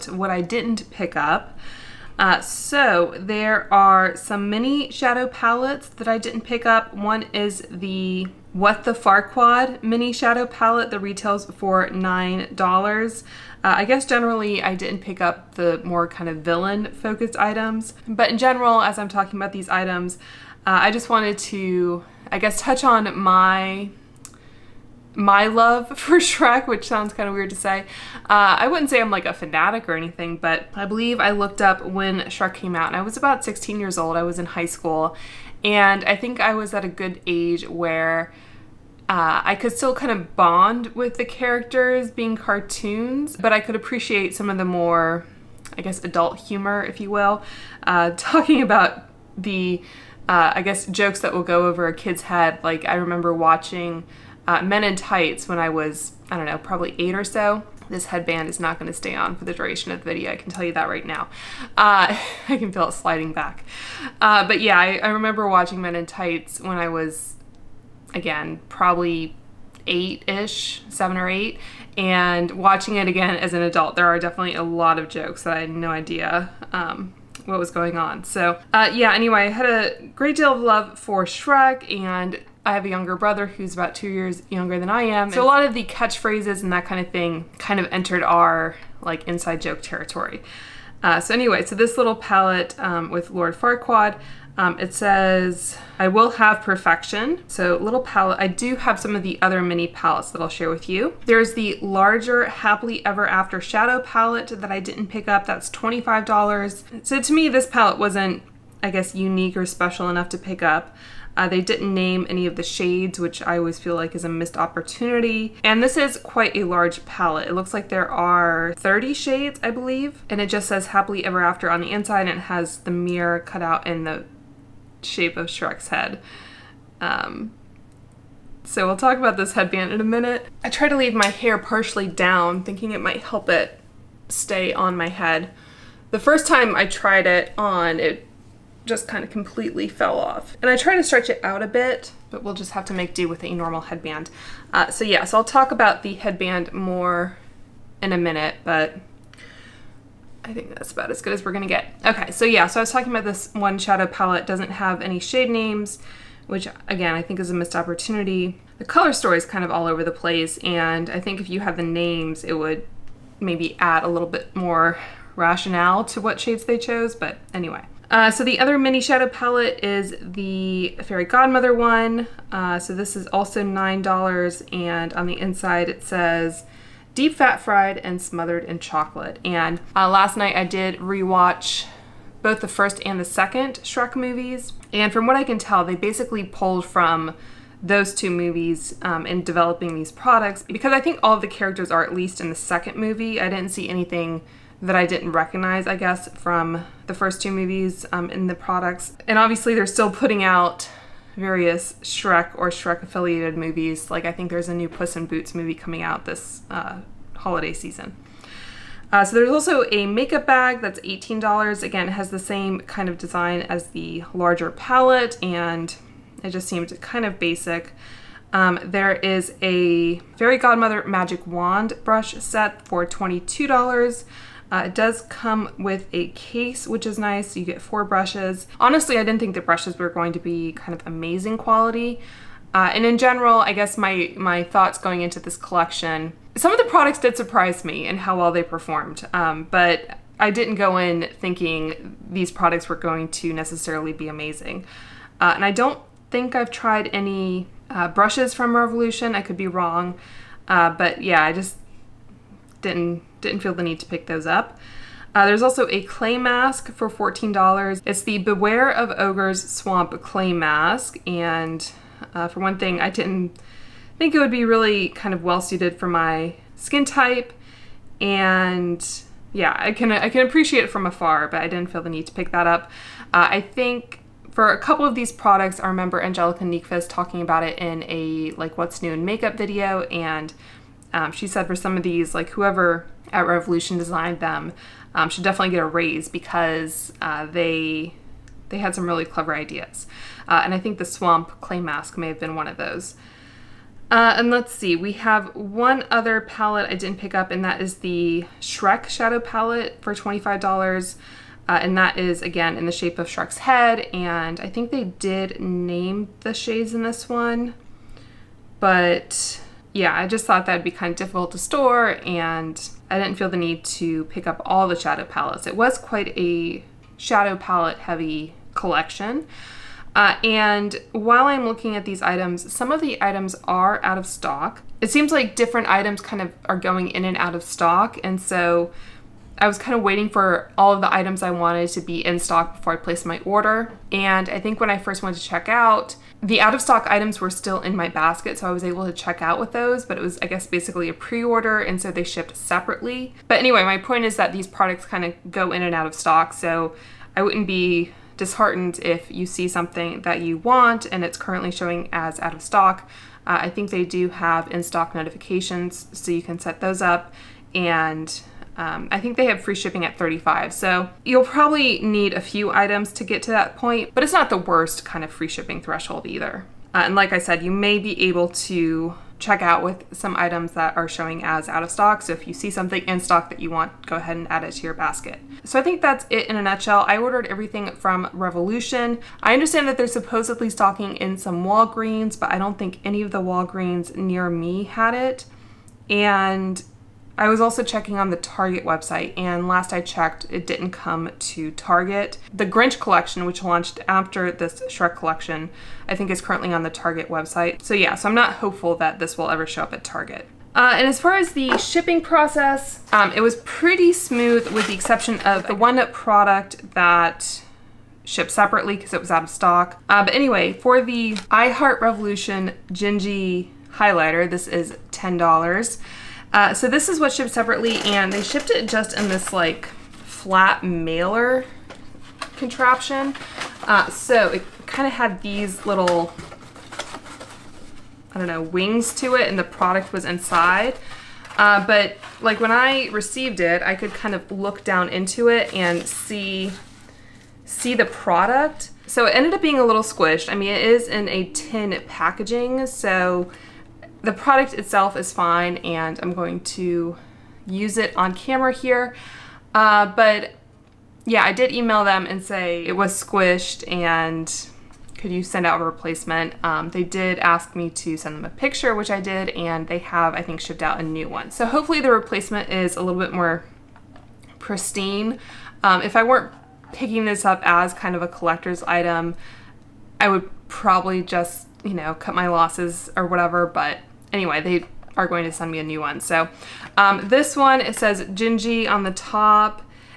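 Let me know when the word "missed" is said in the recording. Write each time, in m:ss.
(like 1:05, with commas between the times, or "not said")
1:54, 2:37.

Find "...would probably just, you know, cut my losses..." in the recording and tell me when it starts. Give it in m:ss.
7:50.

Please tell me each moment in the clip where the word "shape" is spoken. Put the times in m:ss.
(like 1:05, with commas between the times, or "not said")
2:05, 5:02.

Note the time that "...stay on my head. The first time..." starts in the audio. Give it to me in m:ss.
2:14.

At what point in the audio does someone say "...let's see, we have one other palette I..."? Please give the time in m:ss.
4:54.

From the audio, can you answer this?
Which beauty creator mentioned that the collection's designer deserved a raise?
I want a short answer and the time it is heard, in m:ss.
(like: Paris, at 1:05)
Angelica Nyqvist, at 4:36.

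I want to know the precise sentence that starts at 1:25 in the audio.
So a lot of the catchphrases and that kind of thing kind of entered our like inside joke territory.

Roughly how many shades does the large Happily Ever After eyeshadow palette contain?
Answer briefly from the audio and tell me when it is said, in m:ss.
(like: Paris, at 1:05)
30, at 1:58.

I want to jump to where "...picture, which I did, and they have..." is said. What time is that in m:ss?
7:38.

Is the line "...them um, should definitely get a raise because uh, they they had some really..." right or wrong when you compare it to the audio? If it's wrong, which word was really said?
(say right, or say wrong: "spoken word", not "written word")
right.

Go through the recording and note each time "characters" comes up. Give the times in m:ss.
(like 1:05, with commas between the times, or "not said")
0:41, 3:11.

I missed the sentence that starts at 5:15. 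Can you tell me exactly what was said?
It was quite a shadow palette heavy collection.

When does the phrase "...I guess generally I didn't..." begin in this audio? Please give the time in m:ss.
0:13.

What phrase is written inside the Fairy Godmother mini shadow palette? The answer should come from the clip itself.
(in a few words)
Deep fat fried and smothered in chocolate.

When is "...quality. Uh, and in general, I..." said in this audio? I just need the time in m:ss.
3:51.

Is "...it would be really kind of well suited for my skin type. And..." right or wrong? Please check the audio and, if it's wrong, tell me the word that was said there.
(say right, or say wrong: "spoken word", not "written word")
right.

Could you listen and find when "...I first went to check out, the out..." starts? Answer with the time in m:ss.
5:34.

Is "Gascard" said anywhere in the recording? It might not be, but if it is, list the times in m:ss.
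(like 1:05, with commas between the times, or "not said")
not said.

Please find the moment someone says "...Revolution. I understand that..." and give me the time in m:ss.
6:18.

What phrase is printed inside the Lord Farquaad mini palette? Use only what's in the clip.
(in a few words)
I will have perfection.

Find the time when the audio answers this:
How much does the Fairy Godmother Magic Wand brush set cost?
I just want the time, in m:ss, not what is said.
3:43.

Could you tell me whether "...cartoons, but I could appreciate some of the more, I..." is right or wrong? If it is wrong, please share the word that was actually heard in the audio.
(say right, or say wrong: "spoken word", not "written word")
right.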